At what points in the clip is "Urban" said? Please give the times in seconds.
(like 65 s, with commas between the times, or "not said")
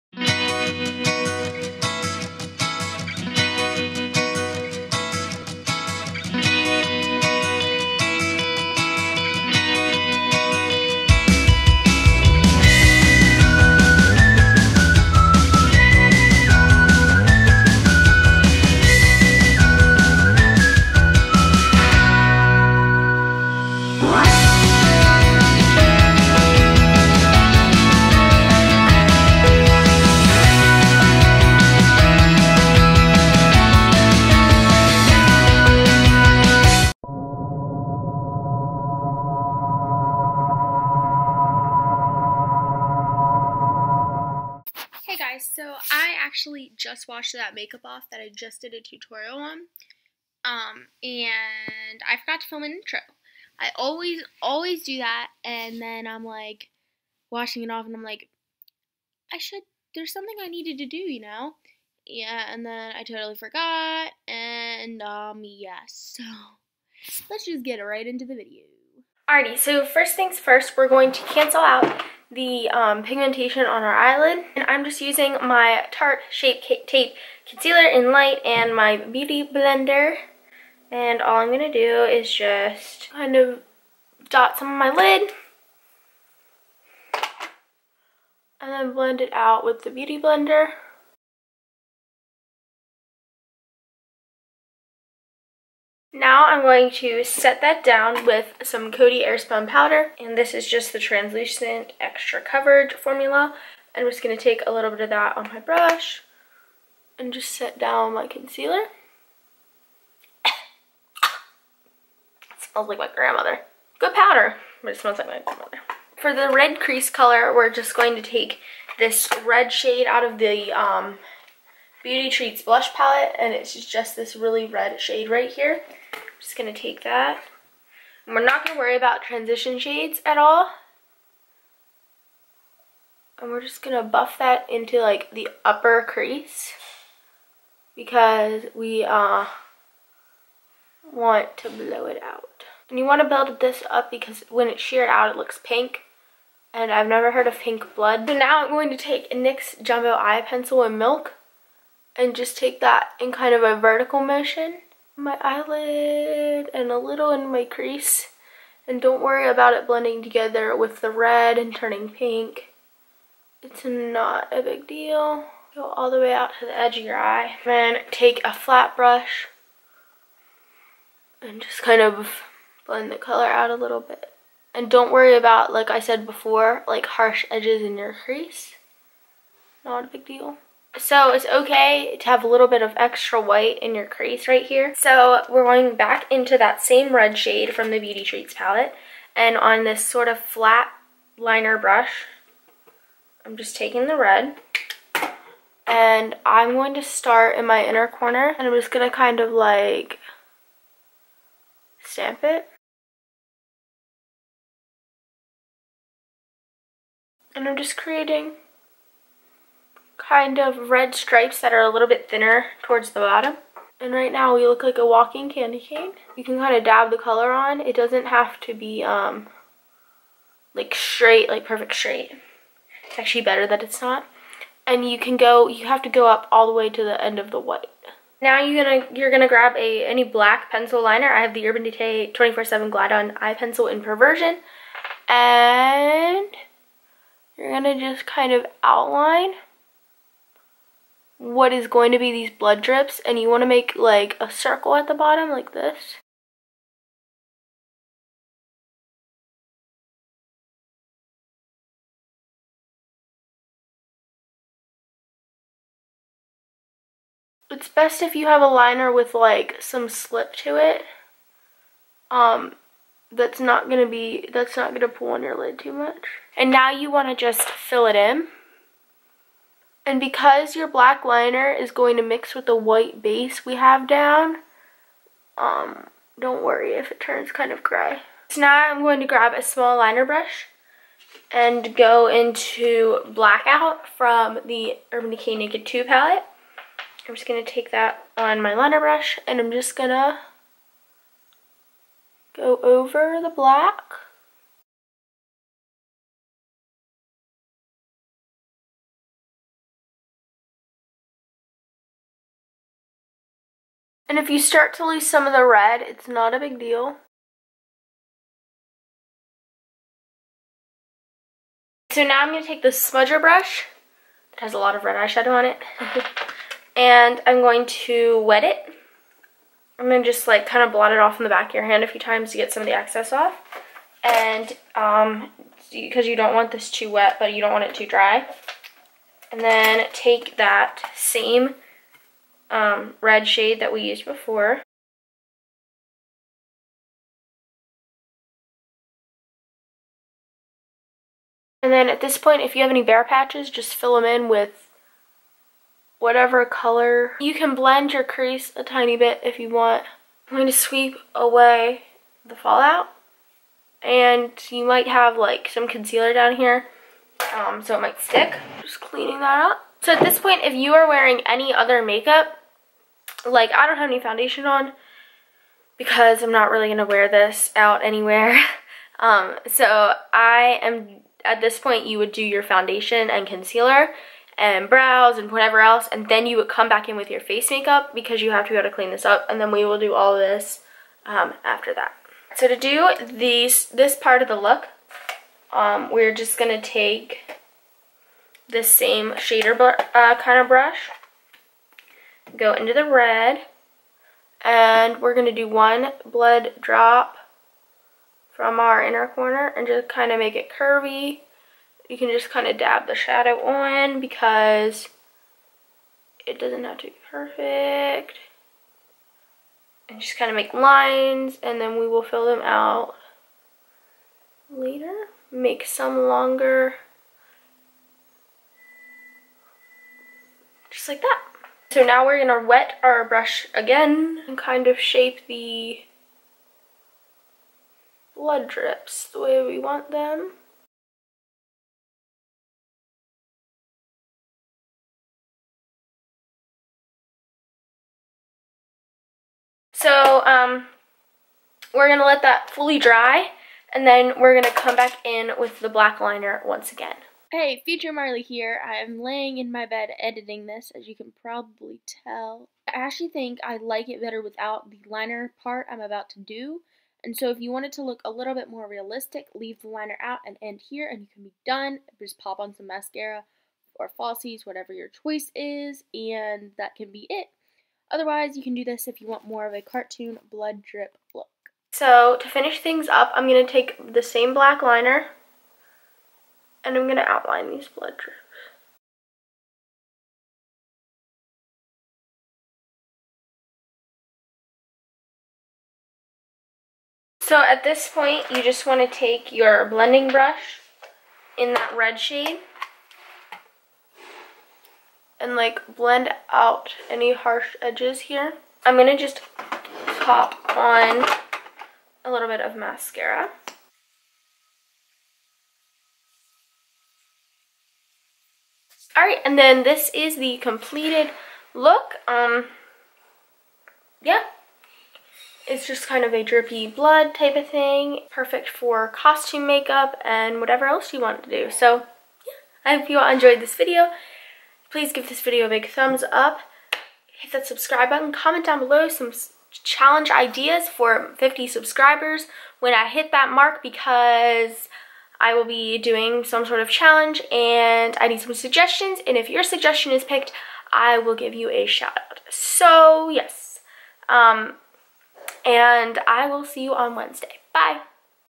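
231 s, 285 s.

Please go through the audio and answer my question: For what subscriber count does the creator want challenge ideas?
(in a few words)
50.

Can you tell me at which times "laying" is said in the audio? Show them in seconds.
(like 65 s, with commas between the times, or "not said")
449 s.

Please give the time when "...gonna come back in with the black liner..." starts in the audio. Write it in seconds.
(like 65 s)
444 s.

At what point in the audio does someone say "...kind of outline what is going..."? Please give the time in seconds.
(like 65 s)
238 s.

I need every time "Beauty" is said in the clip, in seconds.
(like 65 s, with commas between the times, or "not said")
78 s, 89 s, 122 s, 187 s.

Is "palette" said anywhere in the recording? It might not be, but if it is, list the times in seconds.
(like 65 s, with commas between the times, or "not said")
122 s, 188 s, 286 s.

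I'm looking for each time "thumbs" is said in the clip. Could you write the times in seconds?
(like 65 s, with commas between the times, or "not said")
525 s.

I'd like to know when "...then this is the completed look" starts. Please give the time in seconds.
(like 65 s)
509 s.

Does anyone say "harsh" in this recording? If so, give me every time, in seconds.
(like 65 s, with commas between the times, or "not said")
177 s, 497 s.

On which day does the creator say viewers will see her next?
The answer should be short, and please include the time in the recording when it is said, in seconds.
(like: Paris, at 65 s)
Wednesday, at 547 s.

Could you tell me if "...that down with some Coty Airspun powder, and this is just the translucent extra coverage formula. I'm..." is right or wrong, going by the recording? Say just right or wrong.
right.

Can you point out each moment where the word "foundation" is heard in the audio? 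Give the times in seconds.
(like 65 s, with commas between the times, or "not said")
364 s, 372 s.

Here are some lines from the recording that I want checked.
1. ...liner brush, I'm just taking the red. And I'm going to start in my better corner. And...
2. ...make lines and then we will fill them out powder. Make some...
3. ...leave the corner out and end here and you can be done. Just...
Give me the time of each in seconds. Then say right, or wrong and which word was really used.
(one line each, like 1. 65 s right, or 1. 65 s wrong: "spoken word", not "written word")
1. 191 s wrong: "inner", not "better"
2. 410 s wrong: "later", not "powder"
3. 459 s wrong: "liner", not "corner".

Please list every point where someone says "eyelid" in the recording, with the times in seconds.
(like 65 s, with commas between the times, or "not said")
73 s, 155 s.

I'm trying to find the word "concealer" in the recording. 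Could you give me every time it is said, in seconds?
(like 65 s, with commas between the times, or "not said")
77 s, 108 s, 355 s, 373 s.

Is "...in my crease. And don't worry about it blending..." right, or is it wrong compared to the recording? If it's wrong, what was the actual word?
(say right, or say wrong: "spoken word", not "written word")
right.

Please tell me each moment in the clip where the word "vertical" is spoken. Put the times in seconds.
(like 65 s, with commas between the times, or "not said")
153 s.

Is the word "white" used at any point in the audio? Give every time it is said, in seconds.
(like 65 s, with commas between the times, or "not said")
183 s, 227 s, 272 s.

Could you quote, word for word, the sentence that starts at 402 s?
You can just kind of dab the shadow on because it doesn't have to be perfect.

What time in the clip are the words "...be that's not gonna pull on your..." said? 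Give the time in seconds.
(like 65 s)
264 s.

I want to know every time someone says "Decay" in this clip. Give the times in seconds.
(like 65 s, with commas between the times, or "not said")
231 s, 285 s.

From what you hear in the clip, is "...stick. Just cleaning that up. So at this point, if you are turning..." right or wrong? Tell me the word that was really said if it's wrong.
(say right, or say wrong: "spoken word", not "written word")
wrong: "wearing", not "turning".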